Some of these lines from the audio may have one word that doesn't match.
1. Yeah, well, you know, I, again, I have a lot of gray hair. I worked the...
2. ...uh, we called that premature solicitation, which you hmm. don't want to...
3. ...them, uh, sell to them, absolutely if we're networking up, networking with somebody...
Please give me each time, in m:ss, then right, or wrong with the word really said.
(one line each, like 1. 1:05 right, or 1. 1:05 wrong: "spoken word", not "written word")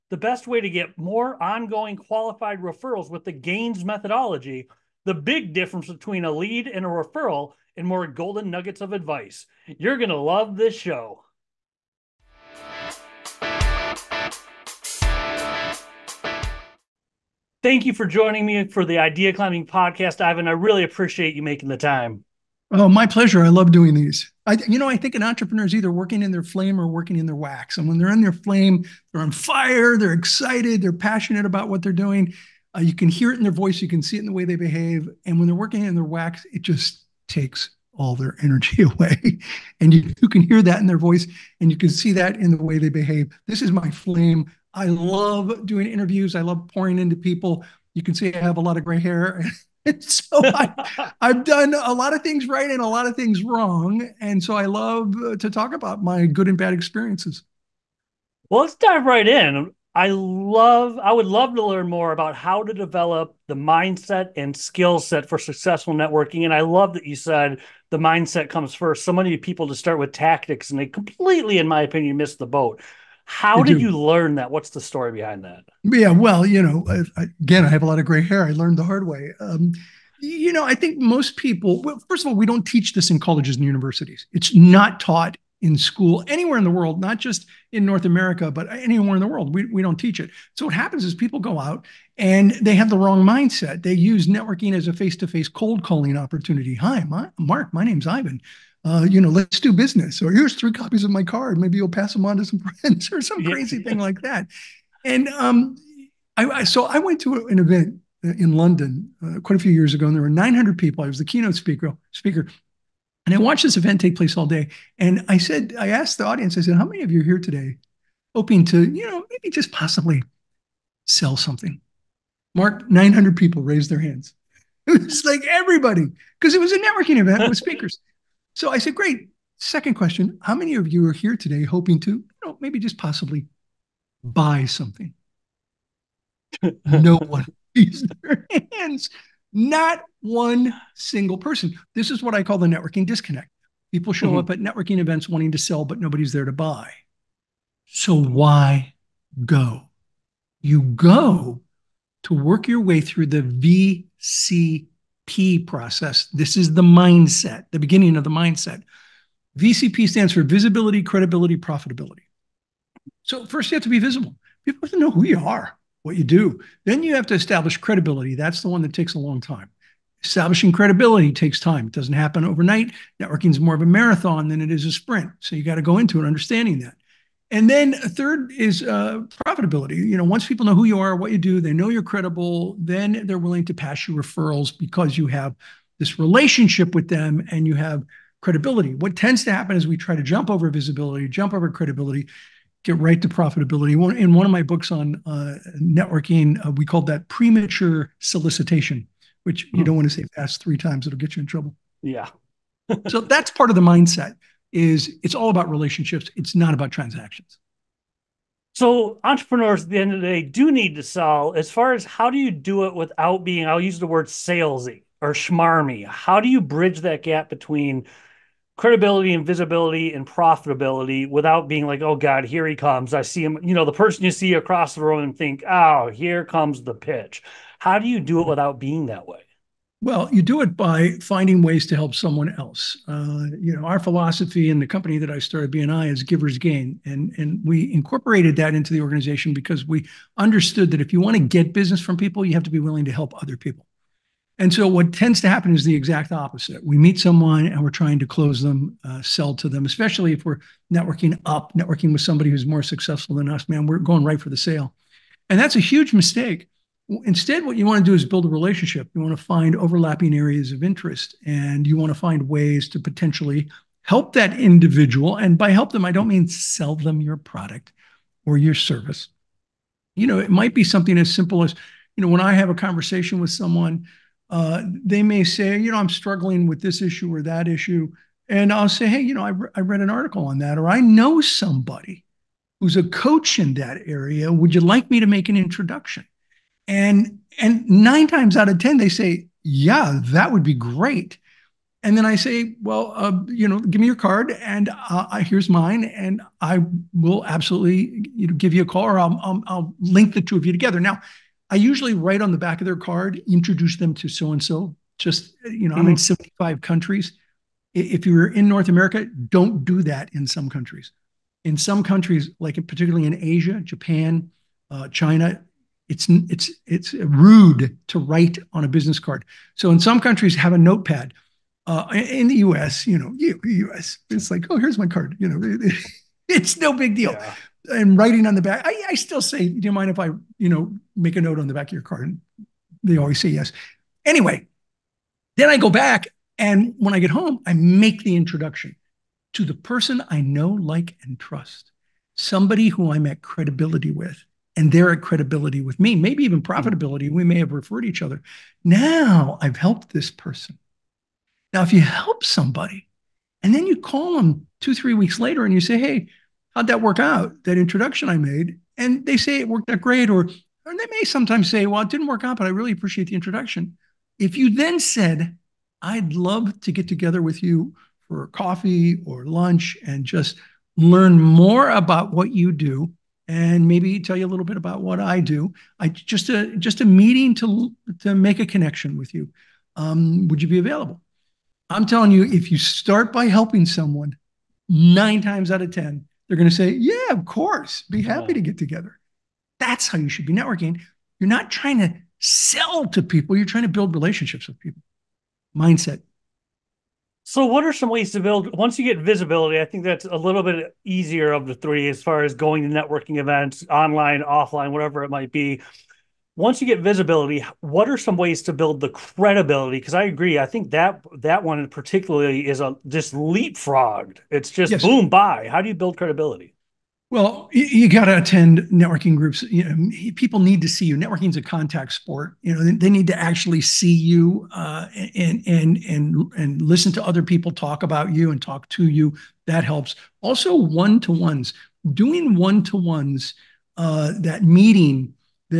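1. 1:15 wrong: "learned", not "worked"
2. 3:16 right
3. 4:08 wrong: "especially", not "absolutely".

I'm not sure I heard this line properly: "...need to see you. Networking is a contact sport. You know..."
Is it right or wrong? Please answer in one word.
right.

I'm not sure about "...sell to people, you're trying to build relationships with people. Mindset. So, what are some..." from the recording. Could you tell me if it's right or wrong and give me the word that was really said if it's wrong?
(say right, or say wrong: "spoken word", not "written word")
right.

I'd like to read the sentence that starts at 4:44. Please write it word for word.
Would you like me to make an introduction?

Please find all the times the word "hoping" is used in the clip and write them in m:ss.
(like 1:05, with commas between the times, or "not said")
1:58, 2:11.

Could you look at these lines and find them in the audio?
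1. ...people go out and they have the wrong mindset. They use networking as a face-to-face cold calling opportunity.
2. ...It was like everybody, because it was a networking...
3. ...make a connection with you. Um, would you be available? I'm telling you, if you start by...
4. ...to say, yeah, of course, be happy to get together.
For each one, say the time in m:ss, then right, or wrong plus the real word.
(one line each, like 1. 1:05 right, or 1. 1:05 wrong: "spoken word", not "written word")
1. 1:31 right
2. 2:04 right
3. 6:18 right
4. 6:26 right.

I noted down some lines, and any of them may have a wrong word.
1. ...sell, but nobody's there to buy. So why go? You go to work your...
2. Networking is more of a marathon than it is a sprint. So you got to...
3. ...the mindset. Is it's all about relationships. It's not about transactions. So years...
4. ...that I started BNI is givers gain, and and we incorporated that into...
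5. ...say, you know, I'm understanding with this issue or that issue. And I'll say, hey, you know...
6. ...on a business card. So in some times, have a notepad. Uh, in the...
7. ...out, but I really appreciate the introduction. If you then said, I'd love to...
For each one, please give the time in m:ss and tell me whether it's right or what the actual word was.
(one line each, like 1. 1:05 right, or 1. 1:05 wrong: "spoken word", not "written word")
1. 2:25 right
2. 2:53 right
3. 3:23 wrong: "entrepreneurs", not "years"
4. 3:55 right
5. 4:35 wrong: "struggling", not "understanding"
6. 5:18 wrong: "countries", not "times"
7. 6:02 right.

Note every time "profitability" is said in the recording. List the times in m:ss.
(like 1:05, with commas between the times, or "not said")
2:41, 2:59, 3:13, 3:40, 5:46.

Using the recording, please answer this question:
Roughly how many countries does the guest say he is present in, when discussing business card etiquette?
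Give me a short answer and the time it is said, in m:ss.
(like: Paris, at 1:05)
75, at 5:06.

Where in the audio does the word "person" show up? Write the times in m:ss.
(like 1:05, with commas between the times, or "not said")
2:21, 3:43, 5:39, 5:50.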